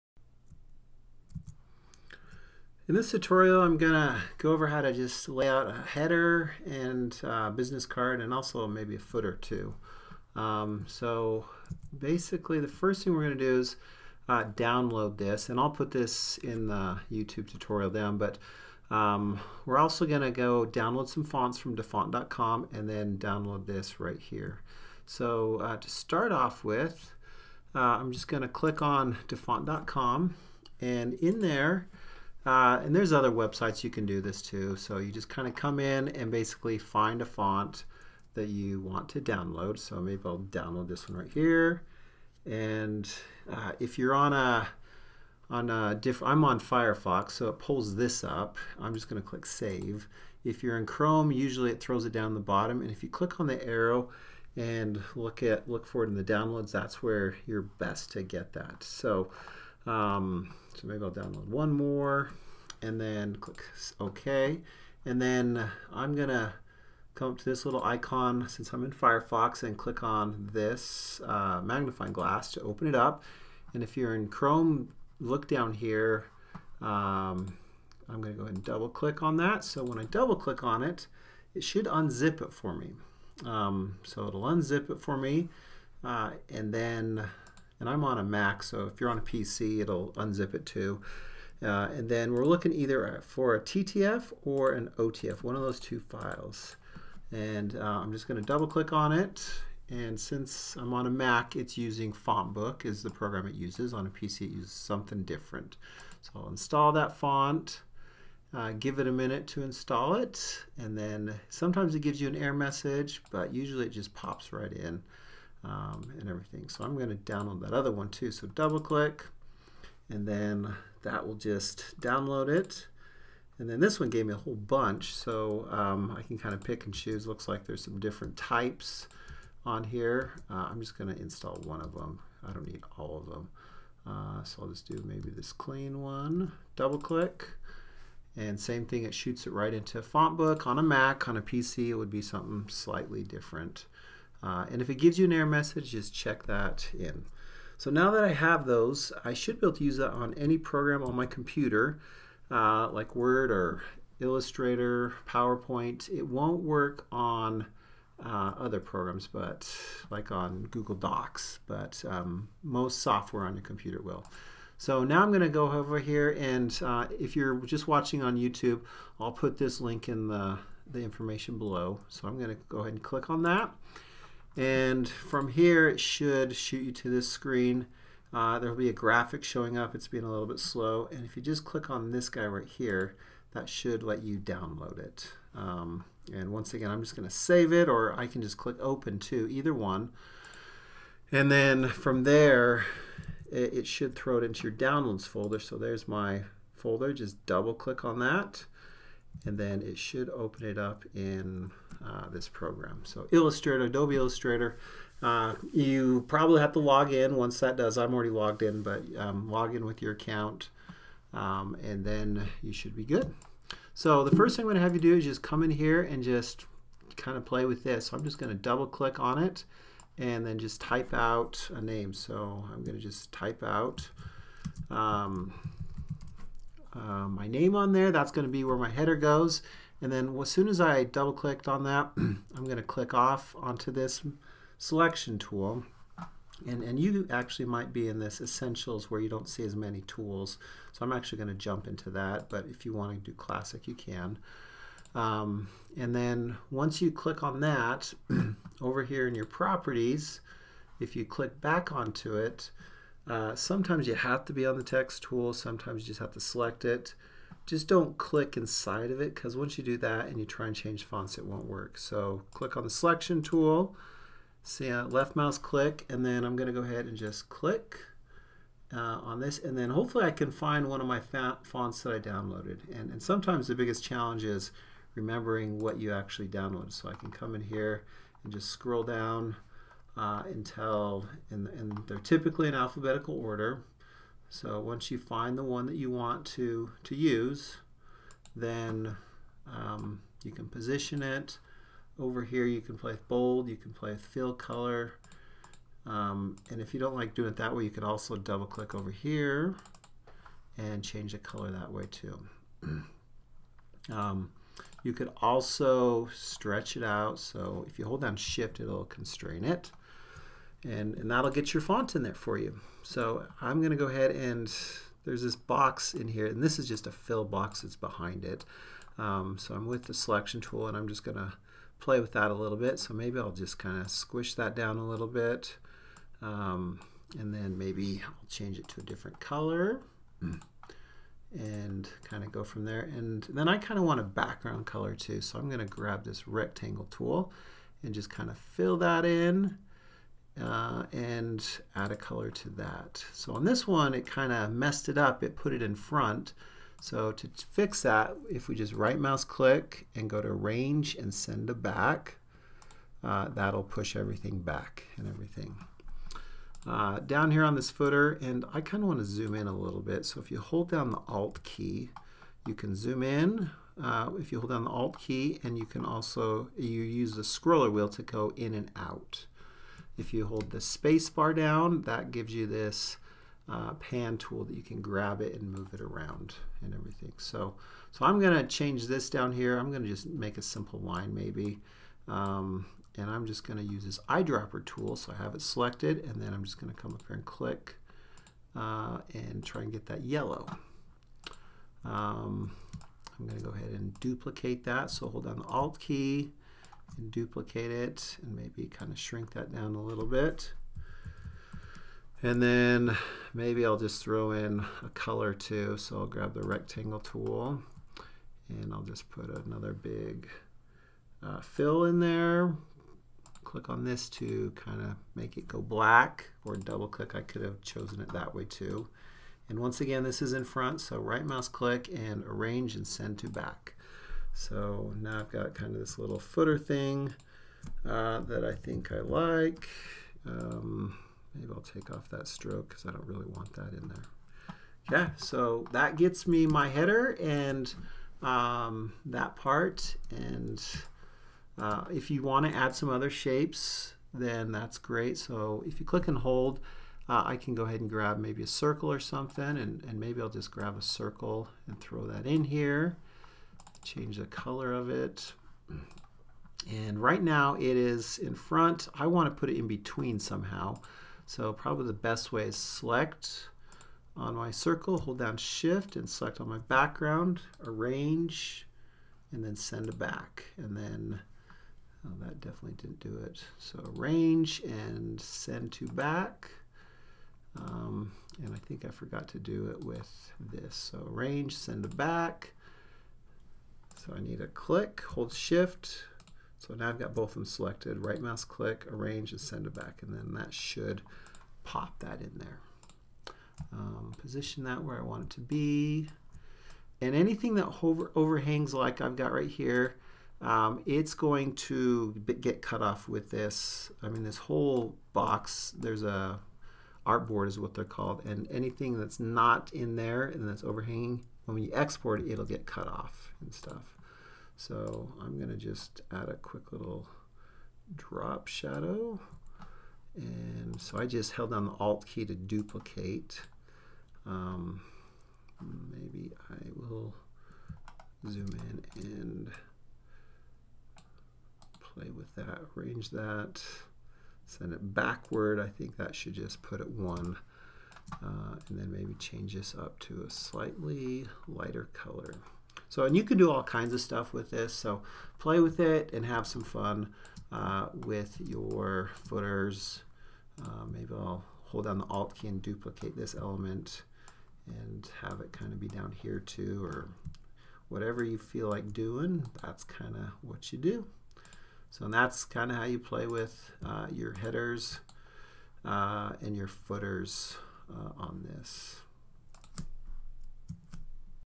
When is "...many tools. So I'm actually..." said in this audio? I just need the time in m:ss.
3:59.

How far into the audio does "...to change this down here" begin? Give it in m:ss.
6:18.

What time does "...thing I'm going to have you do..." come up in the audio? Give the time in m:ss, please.
3:34.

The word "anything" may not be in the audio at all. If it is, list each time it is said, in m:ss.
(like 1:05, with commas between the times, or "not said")
8:17, 8:28.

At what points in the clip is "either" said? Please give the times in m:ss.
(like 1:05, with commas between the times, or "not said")
1:32, 3:09.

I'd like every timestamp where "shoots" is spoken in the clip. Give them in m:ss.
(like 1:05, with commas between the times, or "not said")
2:19, 2:56.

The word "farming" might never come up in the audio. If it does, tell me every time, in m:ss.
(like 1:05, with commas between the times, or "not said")
not said.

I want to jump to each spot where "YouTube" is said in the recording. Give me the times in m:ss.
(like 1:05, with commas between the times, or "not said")
0:17, 2:48.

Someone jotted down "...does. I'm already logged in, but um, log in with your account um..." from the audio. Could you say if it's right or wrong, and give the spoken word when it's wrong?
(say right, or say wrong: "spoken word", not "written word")
right.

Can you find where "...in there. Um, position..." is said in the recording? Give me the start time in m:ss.
8:12.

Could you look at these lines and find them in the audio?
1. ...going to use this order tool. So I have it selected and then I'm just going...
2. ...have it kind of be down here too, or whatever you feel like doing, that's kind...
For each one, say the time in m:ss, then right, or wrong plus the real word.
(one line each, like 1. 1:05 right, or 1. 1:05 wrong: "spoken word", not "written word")
1. 6:23 wrong: "eyedropper", not "order"
2. 9:15 right.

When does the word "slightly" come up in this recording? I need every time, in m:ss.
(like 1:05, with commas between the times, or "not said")
2:22, 9:00.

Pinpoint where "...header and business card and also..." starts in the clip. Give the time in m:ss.
0:05.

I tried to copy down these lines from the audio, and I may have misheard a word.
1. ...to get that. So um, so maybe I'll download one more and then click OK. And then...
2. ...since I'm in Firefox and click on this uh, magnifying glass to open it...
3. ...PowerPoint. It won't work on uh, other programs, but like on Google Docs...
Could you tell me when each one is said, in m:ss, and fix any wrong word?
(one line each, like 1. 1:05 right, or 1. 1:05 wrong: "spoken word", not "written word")
1. 0:58 right
2. 1:08 right
3. 2:35 right.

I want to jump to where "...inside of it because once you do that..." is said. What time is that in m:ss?
4:18.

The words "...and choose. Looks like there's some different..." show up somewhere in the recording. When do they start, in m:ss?
2:06.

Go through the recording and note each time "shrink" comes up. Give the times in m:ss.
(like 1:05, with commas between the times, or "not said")
6:39.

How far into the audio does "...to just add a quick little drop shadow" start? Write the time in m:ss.
8:35.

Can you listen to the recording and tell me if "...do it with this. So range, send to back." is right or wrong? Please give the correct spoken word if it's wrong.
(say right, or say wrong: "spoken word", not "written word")
wrong: "arrange", not "range".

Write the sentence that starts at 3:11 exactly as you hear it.
And then from there, it, it should throw it into your downloads folder.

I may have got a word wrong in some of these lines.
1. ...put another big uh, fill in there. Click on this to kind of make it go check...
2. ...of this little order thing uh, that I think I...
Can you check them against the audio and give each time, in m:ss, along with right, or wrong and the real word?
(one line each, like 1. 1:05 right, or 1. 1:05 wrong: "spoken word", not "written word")
1. 6:49 wrong: "black", not "check"
2. 7:05 wrong: "footer", not "order".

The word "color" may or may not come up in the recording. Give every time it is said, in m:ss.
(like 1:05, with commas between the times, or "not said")
4:54, 5:01, 5:29, 5:34, 5:42, 6:45, 7:34, 9:02.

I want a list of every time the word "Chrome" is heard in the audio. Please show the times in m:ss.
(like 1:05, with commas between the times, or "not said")
0:50, 1:14.